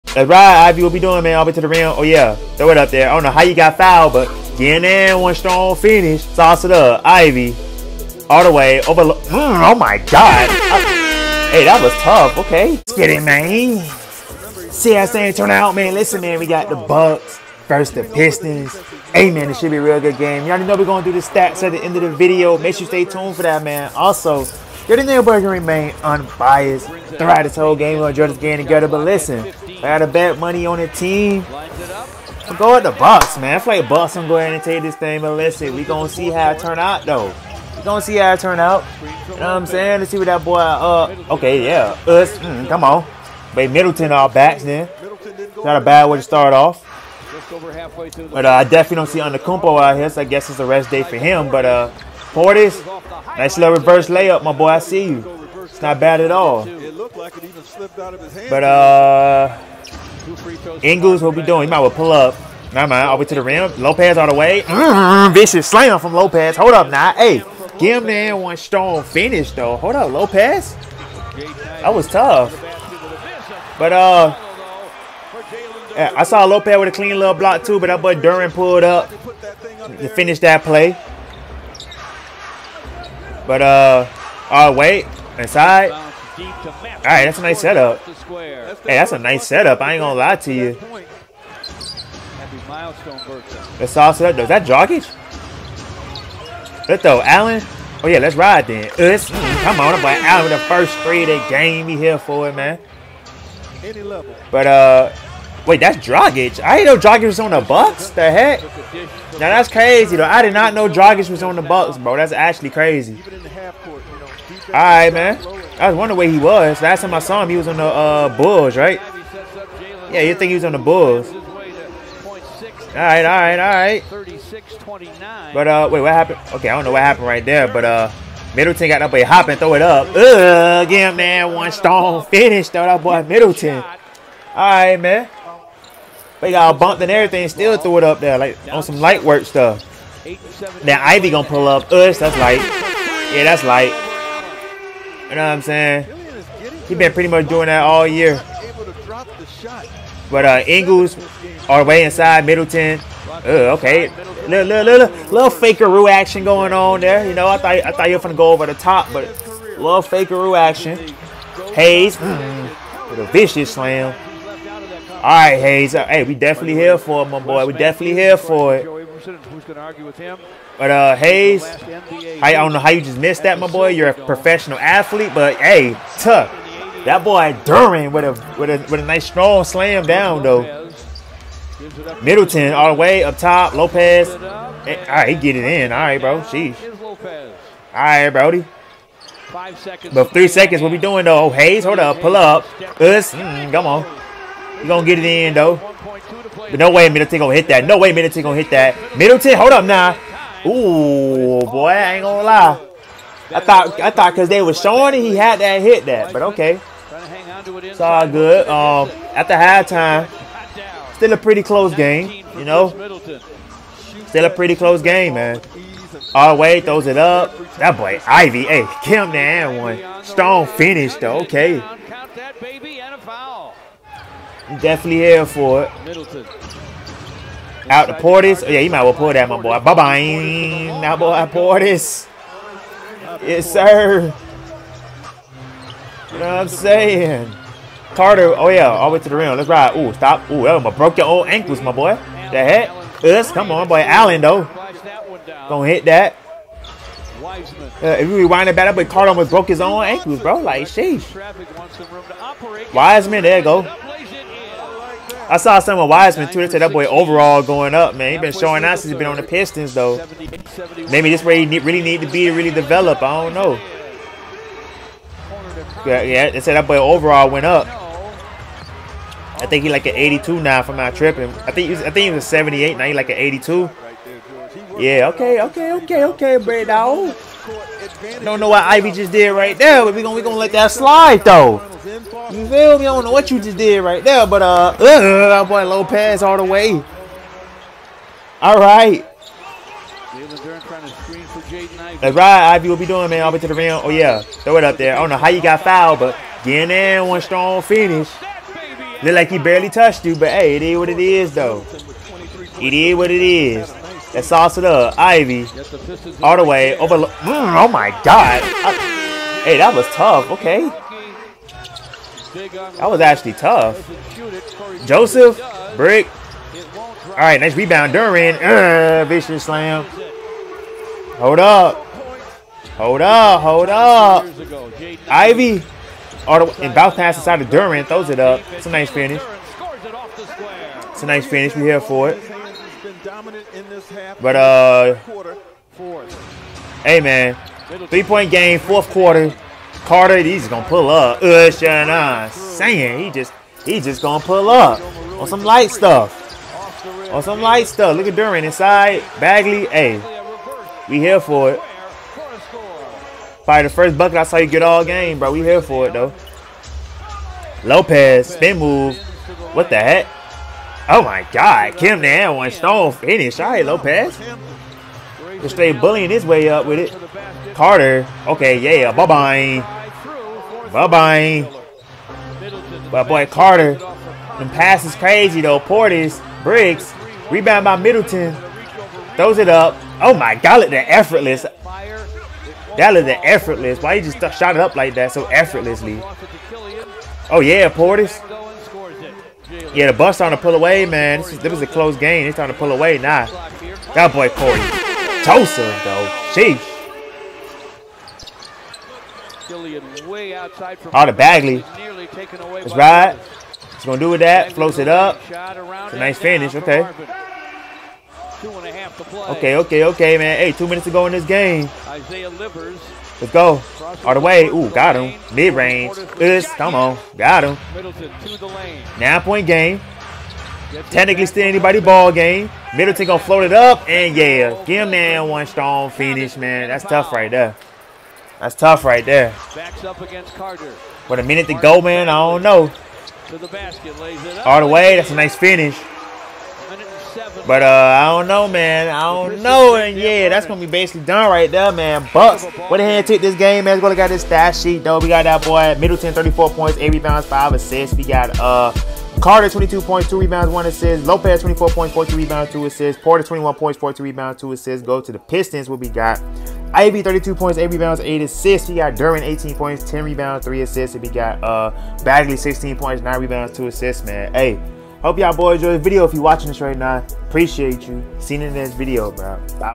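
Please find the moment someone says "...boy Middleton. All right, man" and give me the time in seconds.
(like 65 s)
133 s.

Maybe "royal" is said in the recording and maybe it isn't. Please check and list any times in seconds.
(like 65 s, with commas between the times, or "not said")
not said.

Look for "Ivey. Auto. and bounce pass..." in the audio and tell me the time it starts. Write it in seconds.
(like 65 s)
325 s.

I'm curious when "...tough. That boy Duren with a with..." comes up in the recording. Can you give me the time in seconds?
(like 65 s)
176 s.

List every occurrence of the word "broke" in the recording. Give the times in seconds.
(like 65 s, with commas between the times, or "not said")
240 s, 249 s.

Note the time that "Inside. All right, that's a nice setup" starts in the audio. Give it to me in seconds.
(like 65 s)
85 s.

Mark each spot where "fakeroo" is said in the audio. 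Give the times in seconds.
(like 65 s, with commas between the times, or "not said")
155 s, 160 s.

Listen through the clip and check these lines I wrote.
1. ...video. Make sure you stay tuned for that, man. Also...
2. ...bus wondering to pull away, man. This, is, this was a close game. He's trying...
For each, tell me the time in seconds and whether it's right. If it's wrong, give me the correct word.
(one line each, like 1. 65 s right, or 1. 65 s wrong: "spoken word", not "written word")
1. 22 s right
2. 390 s wrong: "trying", not "wondering".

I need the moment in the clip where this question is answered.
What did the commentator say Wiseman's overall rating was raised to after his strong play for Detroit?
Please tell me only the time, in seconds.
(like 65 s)
272 s.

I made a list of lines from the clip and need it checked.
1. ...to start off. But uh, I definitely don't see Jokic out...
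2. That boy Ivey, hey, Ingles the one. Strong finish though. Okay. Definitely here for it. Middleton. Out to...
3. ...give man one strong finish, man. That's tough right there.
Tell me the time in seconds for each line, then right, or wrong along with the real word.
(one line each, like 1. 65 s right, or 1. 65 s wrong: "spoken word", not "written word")
1. 46 s wrong: "Antetokounmpo", not "Jokic"
2. 217 s wrong: "Kim", not "Ingles"
3. 424 s right.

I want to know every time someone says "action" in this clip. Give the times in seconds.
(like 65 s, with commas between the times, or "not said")
156 s, 160 s.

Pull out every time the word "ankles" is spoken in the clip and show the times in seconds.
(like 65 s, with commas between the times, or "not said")
241 s, 250 s.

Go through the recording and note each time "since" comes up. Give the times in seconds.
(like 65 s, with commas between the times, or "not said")
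258 s.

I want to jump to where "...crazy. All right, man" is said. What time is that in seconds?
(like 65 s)
112 s.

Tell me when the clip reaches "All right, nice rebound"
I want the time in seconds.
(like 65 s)
317 s.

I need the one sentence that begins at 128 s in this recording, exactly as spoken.
Middleton got up a hop and throw it up.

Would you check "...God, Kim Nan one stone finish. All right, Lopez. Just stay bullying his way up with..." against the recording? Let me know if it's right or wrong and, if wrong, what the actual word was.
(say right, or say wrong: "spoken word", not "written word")
right.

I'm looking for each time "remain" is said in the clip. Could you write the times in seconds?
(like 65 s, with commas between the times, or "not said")
25 s.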